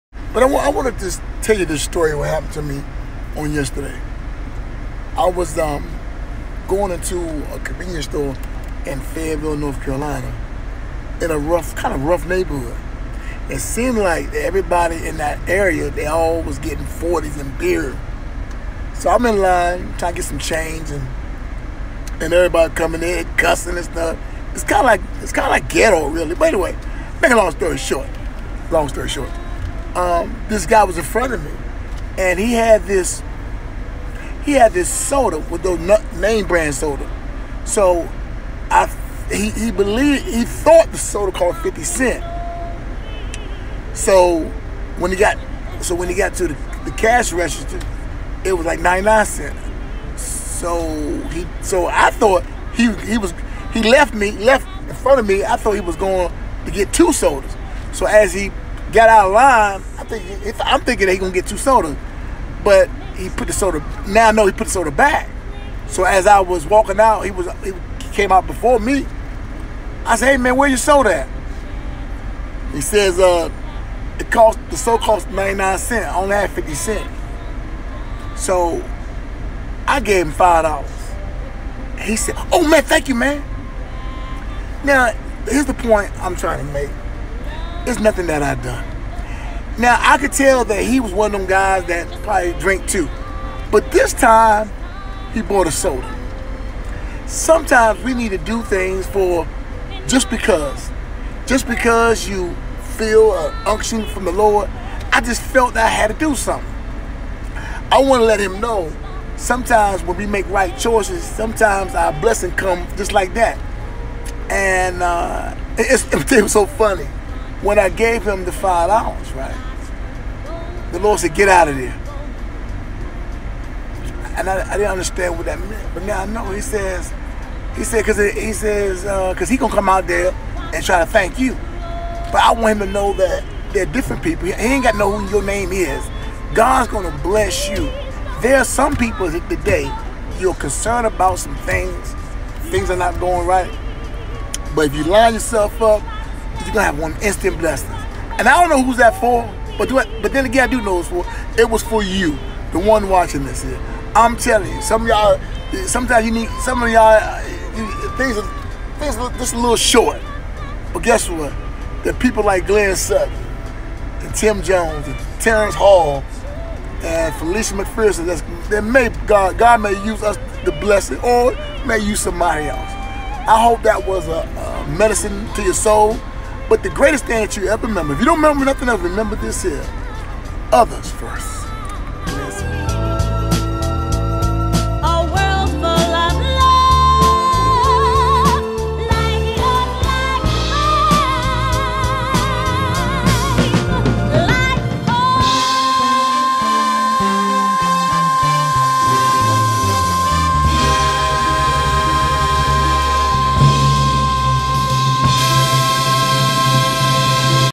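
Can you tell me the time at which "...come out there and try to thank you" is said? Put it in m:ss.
2:09.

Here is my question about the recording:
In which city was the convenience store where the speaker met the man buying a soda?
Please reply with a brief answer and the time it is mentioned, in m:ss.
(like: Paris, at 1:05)
Fayetteville, North Carolina, at 0:09.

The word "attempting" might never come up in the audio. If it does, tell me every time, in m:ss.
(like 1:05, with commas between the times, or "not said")
not said.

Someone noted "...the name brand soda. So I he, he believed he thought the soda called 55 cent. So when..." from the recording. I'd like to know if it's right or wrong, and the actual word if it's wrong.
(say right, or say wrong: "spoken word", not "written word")
wrong: "50", not "55".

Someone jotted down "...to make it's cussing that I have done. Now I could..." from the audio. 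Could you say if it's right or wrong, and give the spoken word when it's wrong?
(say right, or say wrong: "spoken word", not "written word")
wrong: "nothing", not "cussing".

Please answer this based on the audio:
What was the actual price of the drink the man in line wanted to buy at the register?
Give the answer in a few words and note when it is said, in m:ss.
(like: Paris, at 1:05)
99 cents, at 0:48.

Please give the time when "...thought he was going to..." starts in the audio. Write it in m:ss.
0:55.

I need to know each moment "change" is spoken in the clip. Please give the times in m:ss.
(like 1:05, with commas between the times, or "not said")
0:20.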